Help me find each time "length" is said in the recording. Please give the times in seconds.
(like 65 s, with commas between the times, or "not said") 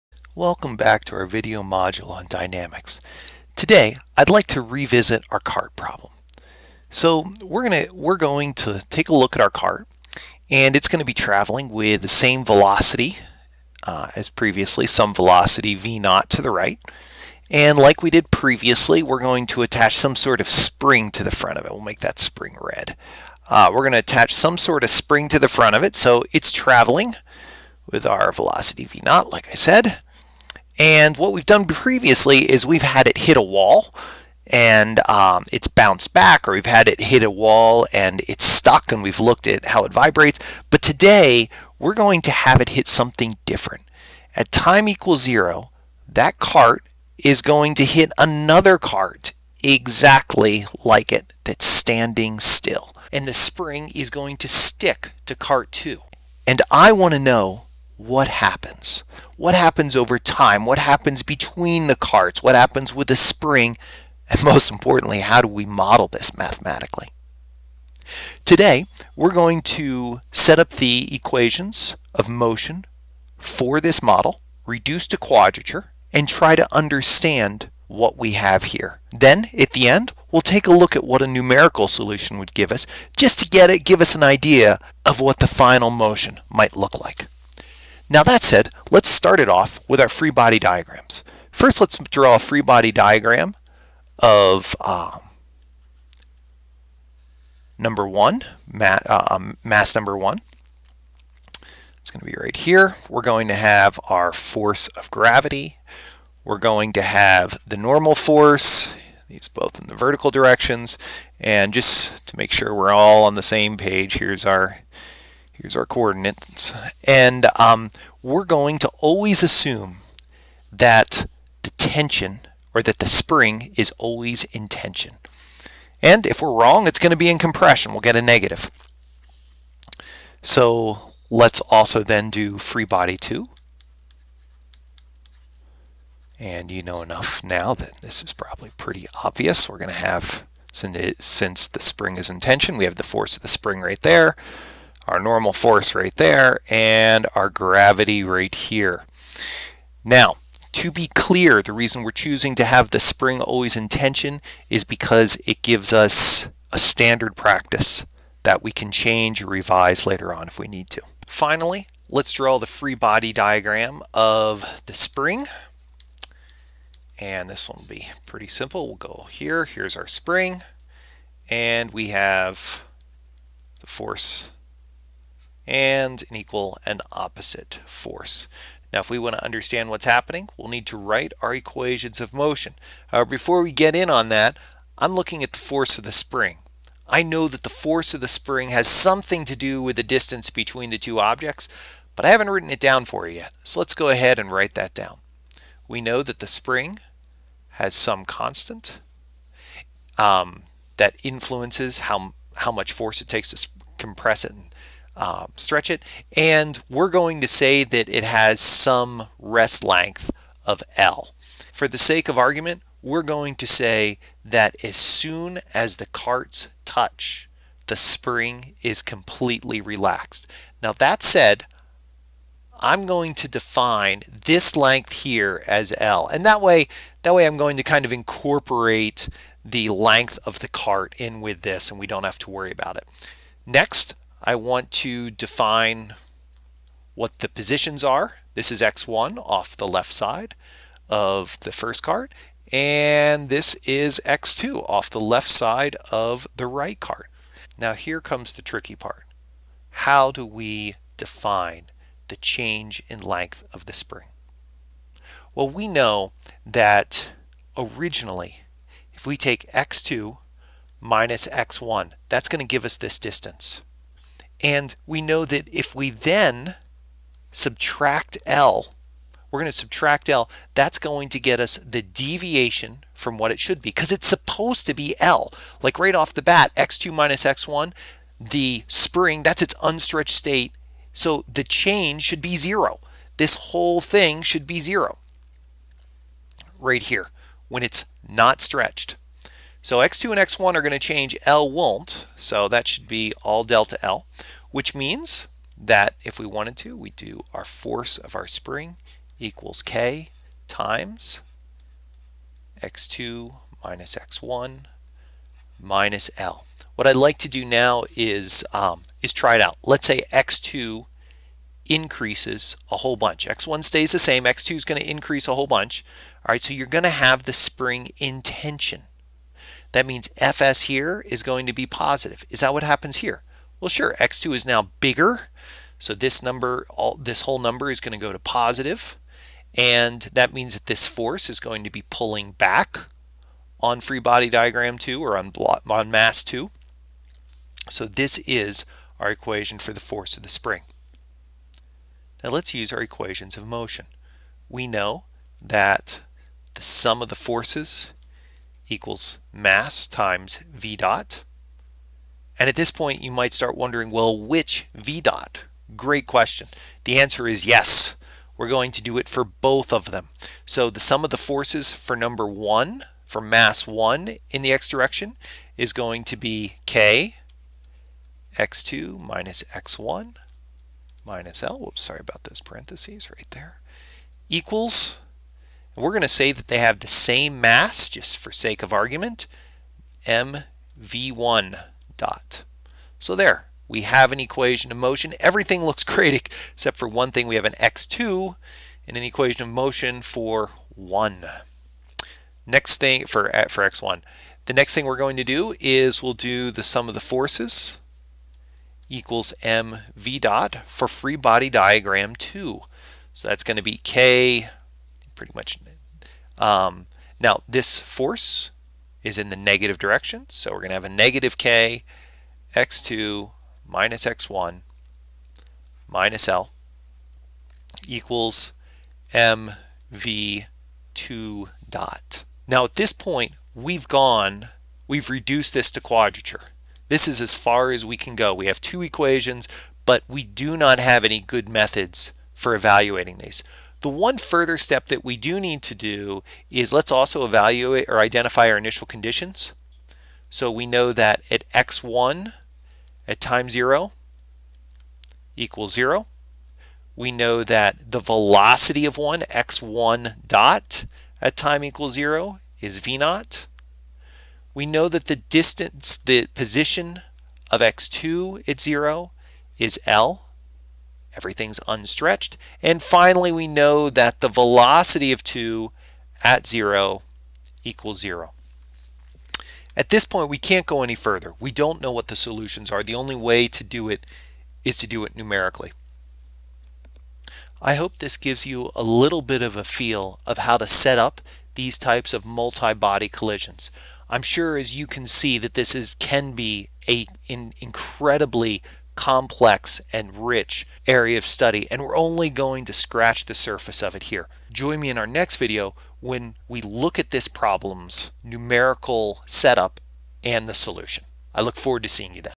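209 s, 224 s, 229 s, 253 s.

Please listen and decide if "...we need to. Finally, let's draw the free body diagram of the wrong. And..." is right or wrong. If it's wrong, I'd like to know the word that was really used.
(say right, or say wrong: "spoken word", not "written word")
wrong: "spring", not "wrong".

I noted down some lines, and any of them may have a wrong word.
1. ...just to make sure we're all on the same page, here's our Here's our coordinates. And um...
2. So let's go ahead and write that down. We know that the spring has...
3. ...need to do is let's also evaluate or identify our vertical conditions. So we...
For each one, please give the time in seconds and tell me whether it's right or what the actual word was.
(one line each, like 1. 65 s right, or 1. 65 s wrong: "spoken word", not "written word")
1. 111 s right
2. 193 s right
3. 435 s wrong: "initial", not "vertical".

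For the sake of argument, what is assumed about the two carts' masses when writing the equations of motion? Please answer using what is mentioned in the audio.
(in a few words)
same mass.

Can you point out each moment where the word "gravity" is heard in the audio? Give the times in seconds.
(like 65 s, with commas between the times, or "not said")
105 s, 147 s.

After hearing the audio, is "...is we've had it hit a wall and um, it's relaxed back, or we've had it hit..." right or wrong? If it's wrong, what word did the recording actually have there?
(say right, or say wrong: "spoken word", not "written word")
wrong: "bounced", not "relaxed".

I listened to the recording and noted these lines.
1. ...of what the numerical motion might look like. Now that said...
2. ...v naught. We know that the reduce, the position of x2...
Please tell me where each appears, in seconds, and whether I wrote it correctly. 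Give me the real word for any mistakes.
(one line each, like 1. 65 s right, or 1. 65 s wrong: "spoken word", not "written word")
1. 85 s wrong: "final", not "numerical"
2. 452 s wrong: "distance", not "reduce".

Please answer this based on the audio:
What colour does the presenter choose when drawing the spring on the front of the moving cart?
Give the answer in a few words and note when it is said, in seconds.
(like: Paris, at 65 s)
red, at 22 s.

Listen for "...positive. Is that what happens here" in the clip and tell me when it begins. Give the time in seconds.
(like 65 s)
321 s.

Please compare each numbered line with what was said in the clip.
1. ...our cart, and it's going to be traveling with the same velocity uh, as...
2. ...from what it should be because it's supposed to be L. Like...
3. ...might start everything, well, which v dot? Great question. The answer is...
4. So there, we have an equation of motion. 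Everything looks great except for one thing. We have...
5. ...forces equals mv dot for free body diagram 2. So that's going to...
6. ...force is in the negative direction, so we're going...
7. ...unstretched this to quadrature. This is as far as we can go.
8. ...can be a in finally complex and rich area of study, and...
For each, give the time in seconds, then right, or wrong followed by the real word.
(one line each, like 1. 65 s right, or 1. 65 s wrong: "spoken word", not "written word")
1. 9 s right
2. 273 s right
3. 353 s wrong: "wondering", not "everything"
4. 383 s right
5. 397 s right
6. 407 s right
7. 425 s wrong: "reduced", not "unstretched"
8. 486 s wrong: "incredibly", not "finally".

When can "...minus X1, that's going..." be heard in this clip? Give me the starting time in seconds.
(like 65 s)
260 s.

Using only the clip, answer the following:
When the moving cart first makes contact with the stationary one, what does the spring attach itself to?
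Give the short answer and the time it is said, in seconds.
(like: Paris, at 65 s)
cart two, at 55 s.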